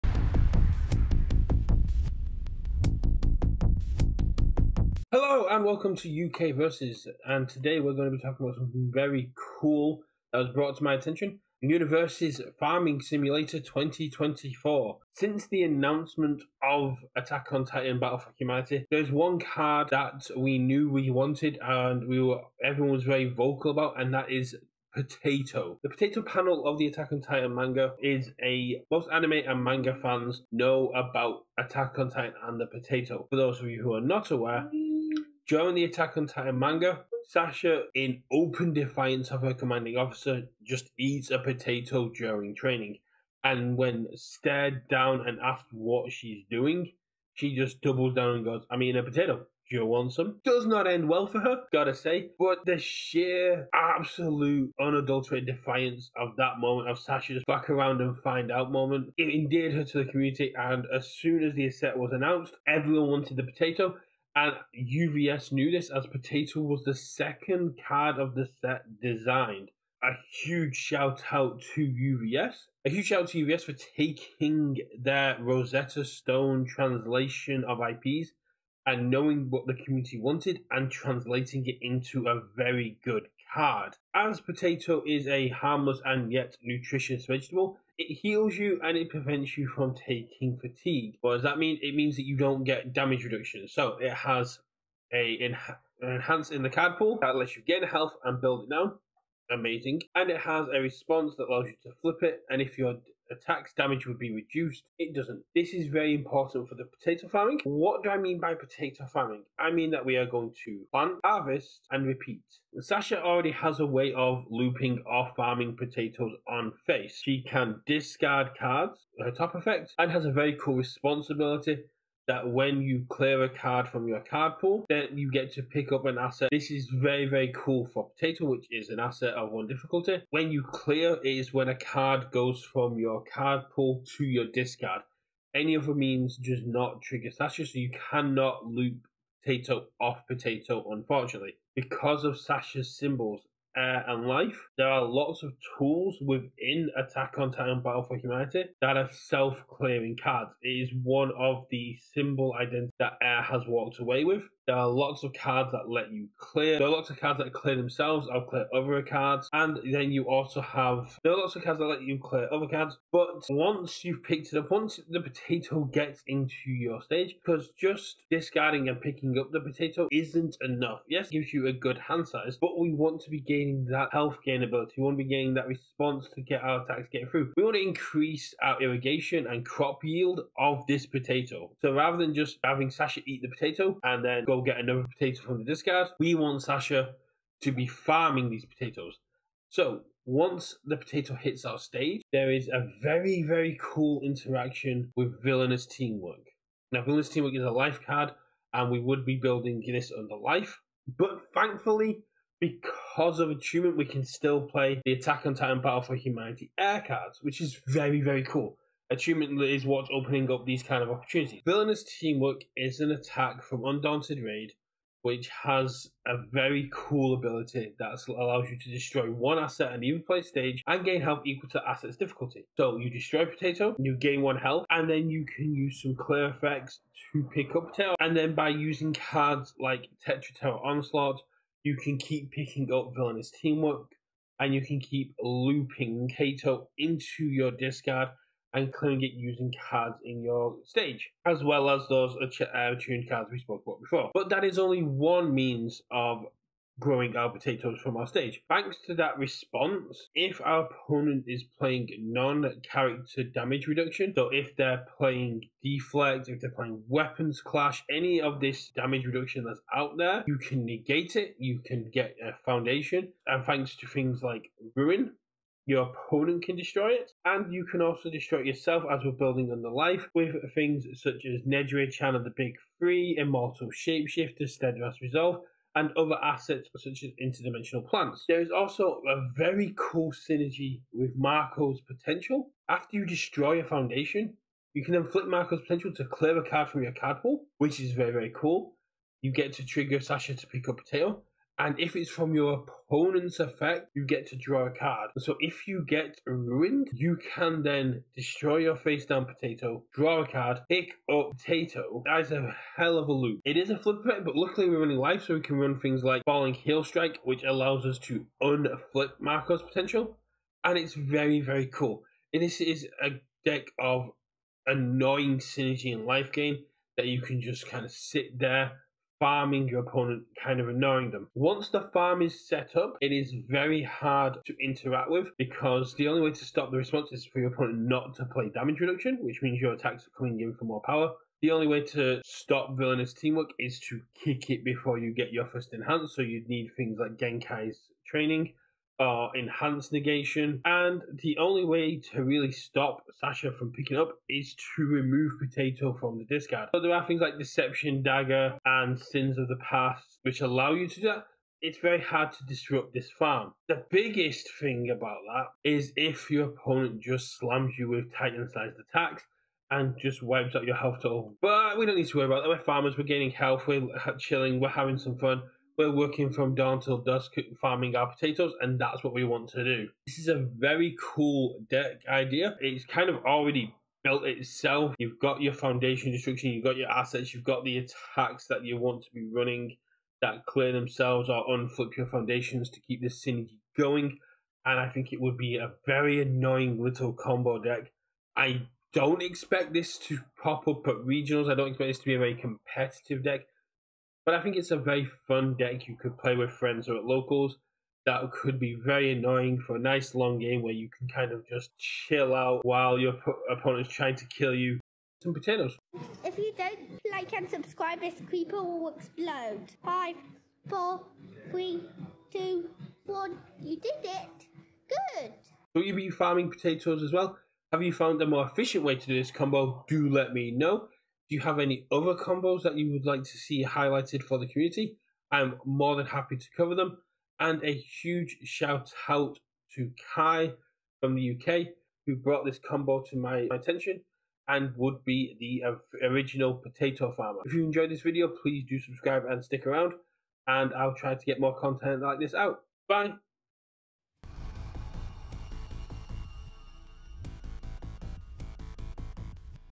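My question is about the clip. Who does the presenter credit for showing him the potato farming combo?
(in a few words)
Kai.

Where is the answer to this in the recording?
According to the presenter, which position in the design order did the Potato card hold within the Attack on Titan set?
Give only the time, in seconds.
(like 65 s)
66 s.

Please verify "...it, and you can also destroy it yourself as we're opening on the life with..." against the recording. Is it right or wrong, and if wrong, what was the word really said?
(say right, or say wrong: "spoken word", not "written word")
wrong: "building", not "opening".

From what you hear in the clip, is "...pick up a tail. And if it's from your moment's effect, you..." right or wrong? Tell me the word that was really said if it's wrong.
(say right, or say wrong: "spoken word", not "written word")
wrong: "opponent", not "moment".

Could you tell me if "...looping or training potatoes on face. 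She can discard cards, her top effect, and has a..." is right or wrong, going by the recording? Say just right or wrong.
wrong.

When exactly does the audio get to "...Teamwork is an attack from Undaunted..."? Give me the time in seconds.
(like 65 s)
212 s.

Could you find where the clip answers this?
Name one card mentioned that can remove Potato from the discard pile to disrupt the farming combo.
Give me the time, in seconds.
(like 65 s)
347 s.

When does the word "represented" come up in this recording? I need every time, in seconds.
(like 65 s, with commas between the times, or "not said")
not said.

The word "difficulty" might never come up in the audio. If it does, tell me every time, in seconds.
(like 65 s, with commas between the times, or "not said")
129 s, 222 s.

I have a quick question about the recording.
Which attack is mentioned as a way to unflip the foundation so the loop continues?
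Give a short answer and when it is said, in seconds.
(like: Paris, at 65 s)
Falling Heel Strike, at 306 s.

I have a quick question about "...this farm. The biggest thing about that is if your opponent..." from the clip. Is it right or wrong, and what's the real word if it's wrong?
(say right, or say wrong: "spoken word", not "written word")
right.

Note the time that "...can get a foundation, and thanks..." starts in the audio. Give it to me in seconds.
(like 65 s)
261 s.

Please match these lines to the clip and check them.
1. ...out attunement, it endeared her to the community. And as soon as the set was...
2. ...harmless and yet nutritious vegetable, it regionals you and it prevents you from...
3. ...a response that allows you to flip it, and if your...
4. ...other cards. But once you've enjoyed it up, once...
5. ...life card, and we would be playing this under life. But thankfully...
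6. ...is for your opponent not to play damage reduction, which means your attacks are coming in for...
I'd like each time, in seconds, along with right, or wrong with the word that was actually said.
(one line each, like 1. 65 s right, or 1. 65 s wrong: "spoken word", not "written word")
1. 58 s wrong: "moment", not "attunement"
2. 85 s wrong: "heals", not "regionals"
3. 100 s right
4. 162 s wrong: "picked", not "enjoyed"
5. 197 s wrong: "building", not "playing"
6. 327 s right.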